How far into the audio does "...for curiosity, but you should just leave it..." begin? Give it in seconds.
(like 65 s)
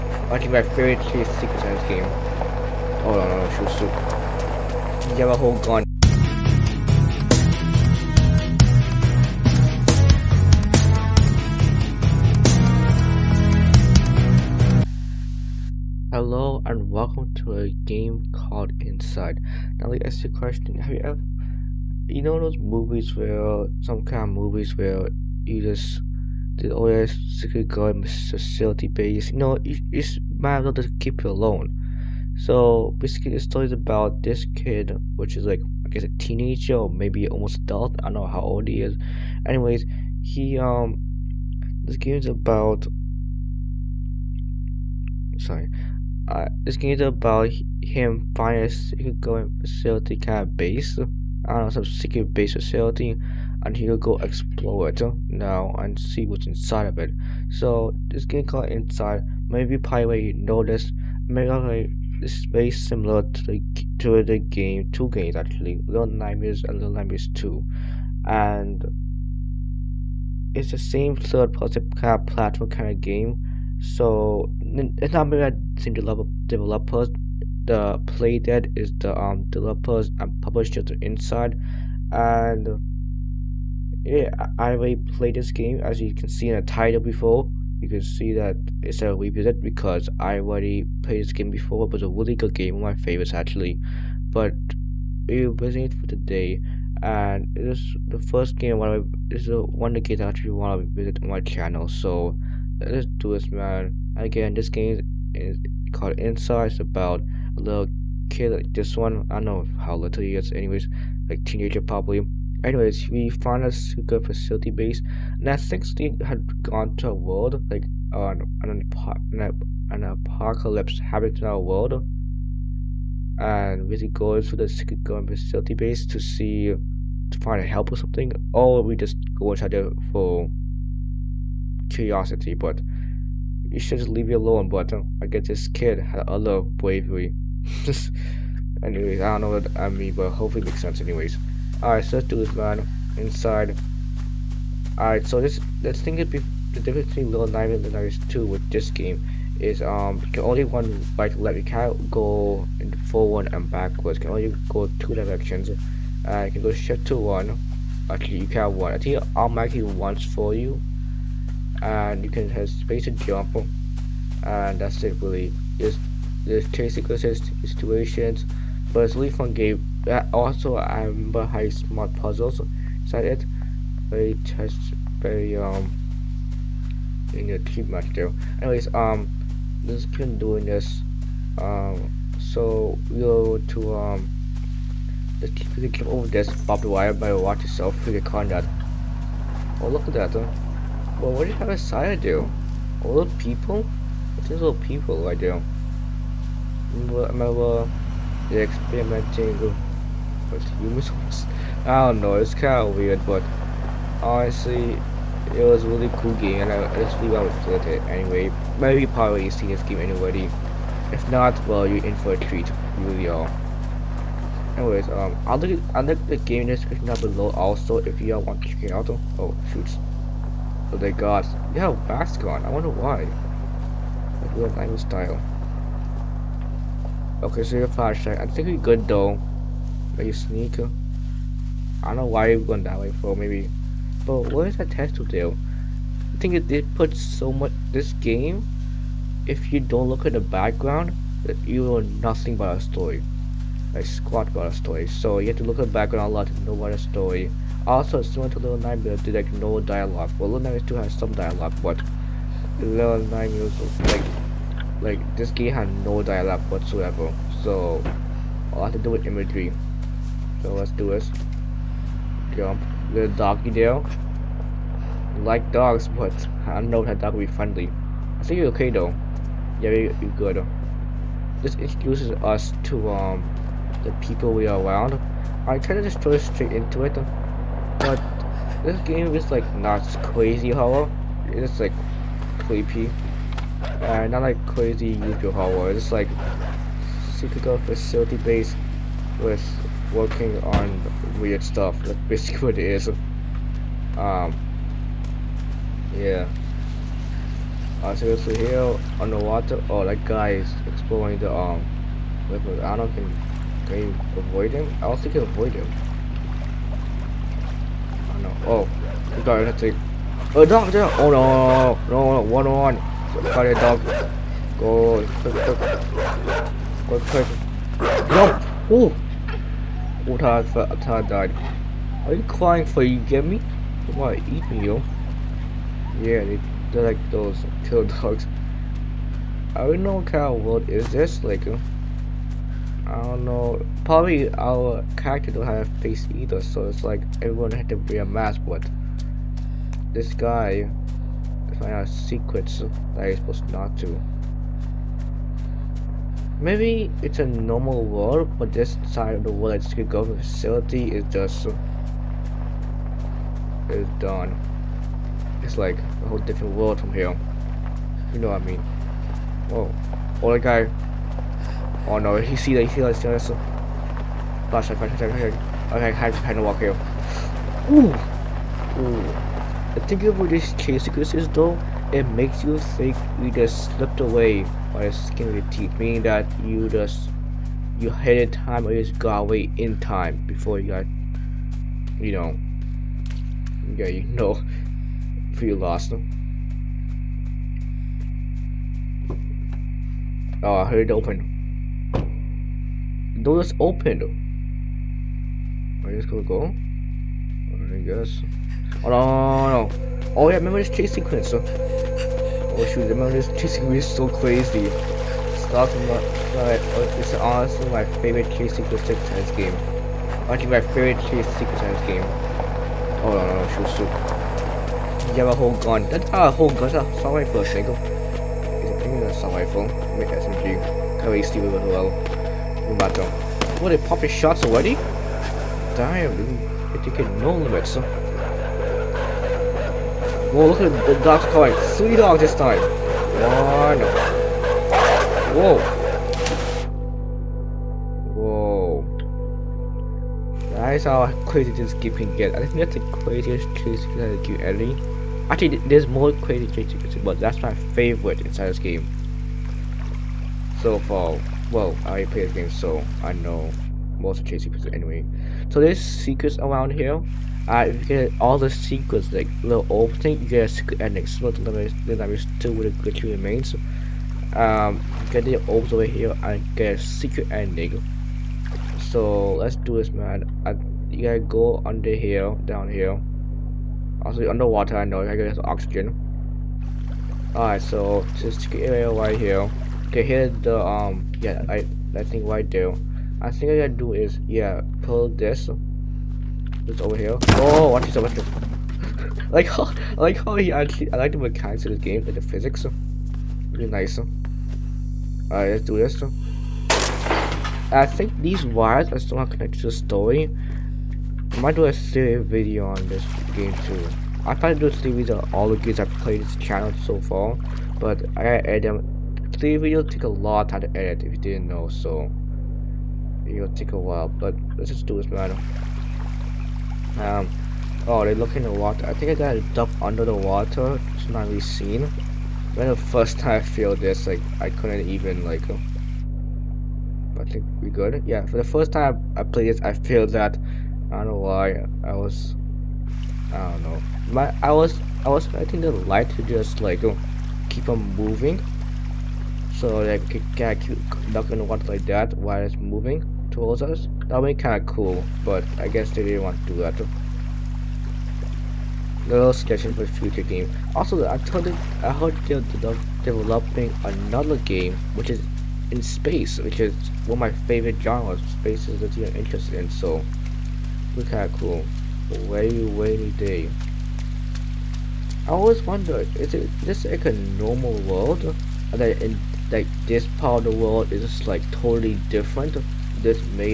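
130 s.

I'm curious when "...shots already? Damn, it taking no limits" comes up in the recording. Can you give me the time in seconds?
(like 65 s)
424 s.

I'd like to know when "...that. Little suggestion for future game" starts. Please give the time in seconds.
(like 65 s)
546 s.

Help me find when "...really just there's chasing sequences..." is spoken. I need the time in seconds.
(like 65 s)
165 s.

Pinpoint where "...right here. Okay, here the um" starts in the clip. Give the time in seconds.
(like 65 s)
479 s.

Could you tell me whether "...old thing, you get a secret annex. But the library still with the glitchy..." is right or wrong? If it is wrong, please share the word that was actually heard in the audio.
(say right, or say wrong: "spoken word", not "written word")
right.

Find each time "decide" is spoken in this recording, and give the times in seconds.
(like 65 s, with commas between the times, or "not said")
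not said.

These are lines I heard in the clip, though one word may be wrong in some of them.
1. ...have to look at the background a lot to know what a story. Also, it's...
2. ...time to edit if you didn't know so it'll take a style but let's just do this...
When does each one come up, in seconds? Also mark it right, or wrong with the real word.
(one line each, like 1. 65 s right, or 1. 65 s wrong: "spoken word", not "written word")
1. 245 s right
2. 510 s wrong: "while", not "style".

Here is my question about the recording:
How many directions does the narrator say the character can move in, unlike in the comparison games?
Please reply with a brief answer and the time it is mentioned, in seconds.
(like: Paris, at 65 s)
2, at 154 s.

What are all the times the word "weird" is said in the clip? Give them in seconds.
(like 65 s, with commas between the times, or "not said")
202 s, 291 s.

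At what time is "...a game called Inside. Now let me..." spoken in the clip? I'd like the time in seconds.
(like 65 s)
17 s.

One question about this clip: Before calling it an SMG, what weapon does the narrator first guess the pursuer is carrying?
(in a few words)
Rifle.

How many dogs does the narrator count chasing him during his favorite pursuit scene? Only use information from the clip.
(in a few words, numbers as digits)
3.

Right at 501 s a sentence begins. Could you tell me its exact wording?
I might do a series video on this game too.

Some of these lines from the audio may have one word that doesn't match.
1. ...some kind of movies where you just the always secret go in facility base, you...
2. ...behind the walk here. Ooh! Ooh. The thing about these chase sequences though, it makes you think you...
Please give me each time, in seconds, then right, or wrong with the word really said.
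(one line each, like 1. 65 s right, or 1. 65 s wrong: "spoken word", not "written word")
1. 23 s right
2. 366 s right.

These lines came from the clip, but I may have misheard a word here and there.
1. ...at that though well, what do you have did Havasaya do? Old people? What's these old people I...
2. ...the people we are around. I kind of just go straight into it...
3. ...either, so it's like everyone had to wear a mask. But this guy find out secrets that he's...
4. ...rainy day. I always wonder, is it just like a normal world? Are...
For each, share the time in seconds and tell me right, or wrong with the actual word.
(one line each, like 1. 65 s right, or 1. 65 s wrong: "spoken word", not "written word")
1. 190 s right
2. 274 s right
3. 336 s right
4. 562 s right.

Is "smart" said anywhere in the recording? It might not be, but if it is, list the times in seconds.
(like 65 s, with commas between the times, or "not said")
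171 s.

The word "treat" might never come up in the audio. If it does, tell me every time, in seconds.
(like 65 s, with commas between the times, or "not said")
212 s.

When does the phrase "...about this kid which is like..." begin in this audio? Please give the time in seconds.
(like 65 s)
33 s.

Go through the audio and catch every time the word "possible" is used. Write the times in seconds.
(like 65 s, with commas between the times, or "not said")
not said.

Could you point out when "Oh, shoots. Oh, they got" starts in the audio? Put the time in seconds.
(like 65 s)
219 s.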